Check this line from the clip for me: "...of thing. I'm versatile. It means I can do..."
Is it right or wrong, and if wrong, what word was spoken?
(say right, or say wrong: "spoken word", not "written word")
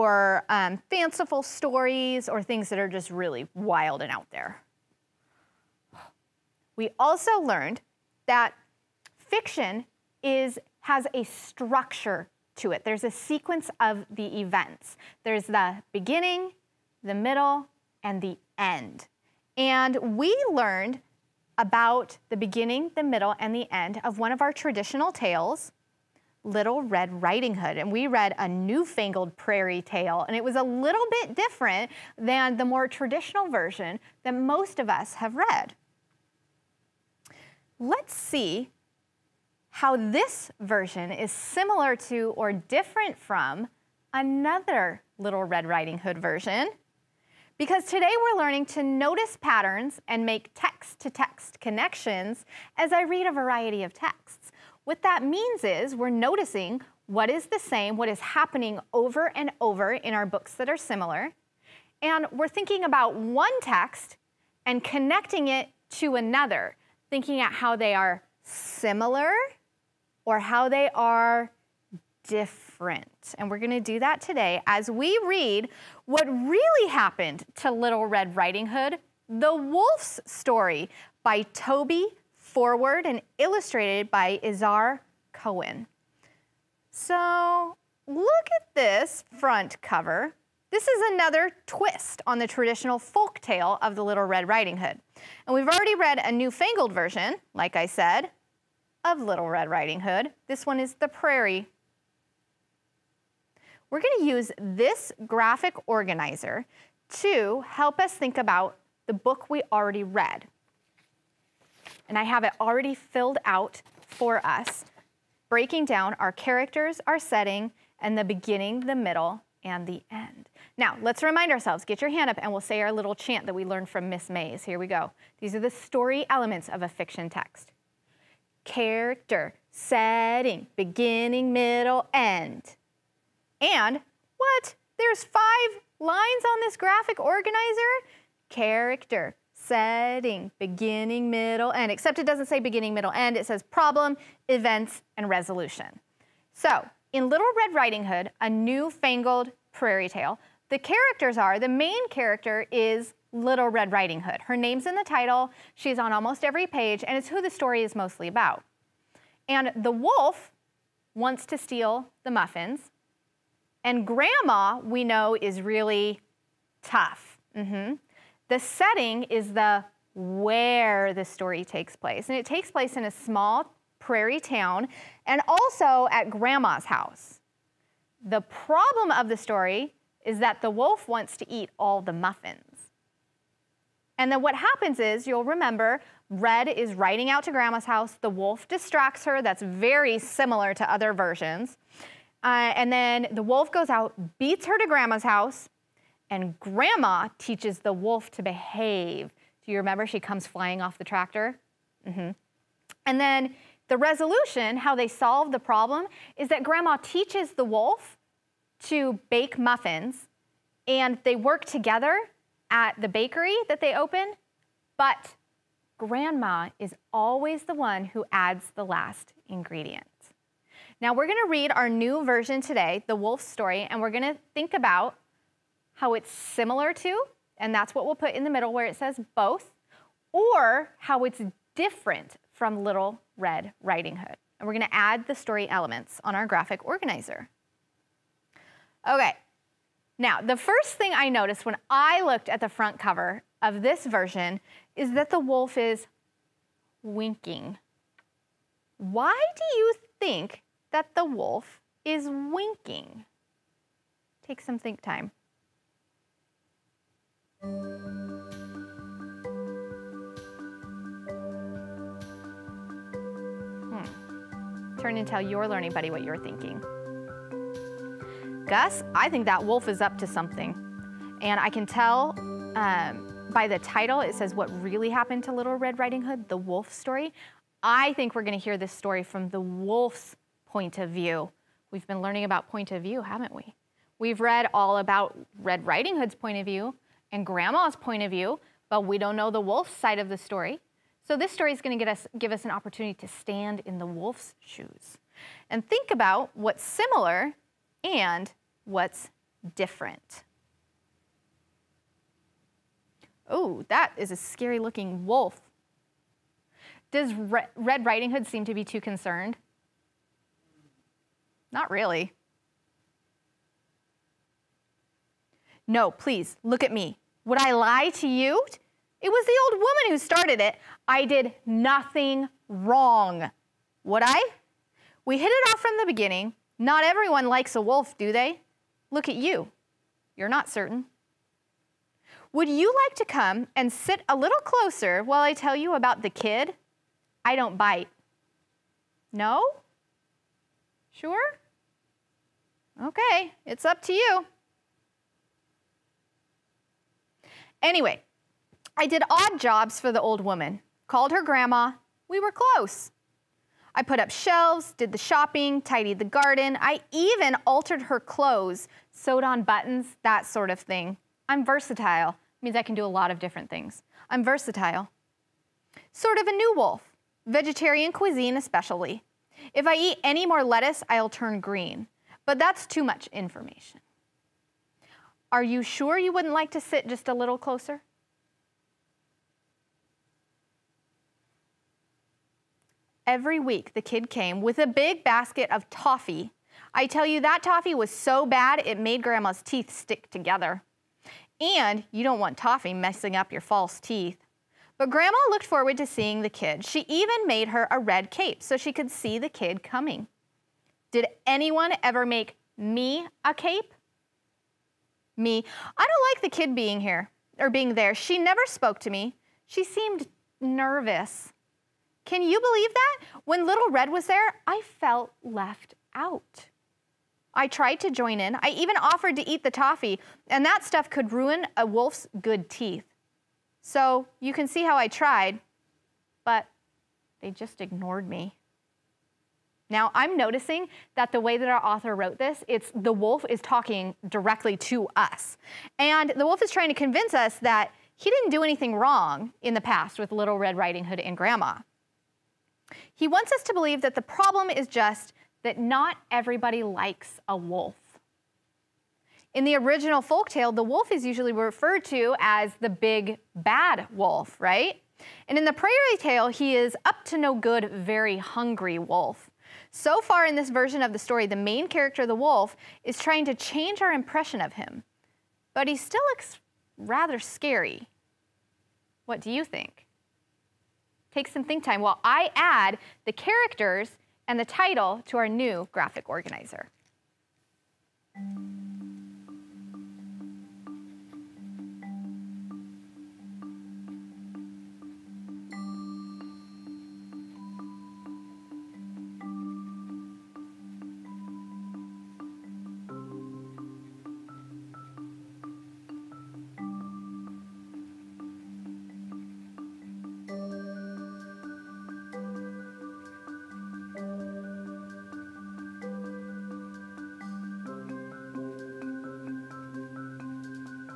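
right.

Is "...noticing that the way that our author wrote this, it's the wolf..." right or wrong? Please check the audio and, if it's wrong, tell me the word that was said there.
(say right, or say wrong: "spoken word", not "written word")
right.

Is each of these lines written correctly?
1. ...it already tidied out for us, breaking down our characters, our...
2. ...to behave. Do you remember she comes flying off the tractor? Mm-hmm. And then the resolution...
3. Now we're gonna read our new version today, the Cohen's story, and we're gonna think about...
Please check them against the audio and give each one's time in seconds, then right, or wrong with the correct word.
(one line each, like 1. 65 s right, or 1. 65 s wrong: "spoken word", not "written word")
1. 112 s wrong: "filled", not "tidied"
2. 198 s right
3. 221 s wrong: "Wolf", not "Cohen".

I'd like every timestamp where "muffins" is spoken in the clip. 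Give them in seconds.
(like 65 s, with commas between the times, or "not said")
162 s, 182 s, 209 s.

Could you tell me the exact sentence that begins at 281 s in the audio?
We've been learning about point of view, haven't we?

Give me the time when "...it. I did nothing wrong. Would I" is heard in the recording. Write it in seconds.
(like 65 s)
320 s.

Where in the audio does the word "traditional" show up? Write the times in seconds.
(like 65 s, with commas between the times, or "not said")
24 s, 32 s, 92 s.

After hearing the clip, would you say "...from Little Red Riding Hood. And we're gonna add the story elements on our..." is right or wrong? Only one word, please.
right.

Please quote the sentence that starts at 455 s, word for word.
And in the prairie tale, he is up to no good, very hungry wolf.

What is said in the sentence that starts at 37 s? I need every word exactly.
Let's see how this version is similar to or different from another Little Red Riding Hood version.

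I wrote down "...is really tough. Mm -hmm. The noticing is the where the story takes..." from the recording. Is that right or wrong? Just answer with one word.
wrong.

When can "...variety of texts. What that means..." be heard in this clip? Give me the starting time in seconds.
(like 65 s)
53 s.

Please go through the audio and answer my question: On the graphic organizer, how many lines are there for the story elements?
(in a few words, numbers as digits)
5.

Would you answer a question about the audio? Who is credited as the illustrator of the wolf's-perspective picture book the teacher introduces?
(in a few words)
Izhar Cohen.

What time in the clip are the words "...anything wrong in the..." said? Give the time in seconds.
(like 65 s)
438 s.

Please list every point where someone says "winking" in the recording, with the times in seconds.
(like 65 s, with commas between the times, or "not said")
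247 s, 252 s.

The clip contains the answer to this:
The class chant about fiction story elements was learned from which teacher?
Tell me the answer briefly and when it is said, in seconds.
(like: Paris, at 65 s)
Miss Mays, at 124 s.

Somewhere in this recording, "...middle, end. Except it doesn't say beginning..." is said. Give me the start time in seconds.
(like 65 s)
141 s.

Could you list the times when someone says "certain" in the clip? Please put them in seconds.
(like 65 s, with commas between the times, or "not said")
330 s.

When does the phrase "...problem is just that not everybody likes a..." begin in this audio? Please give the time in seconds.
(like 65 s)
444 s.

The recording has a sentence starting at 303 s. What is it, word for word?
Oh, that is a scary looking wolf.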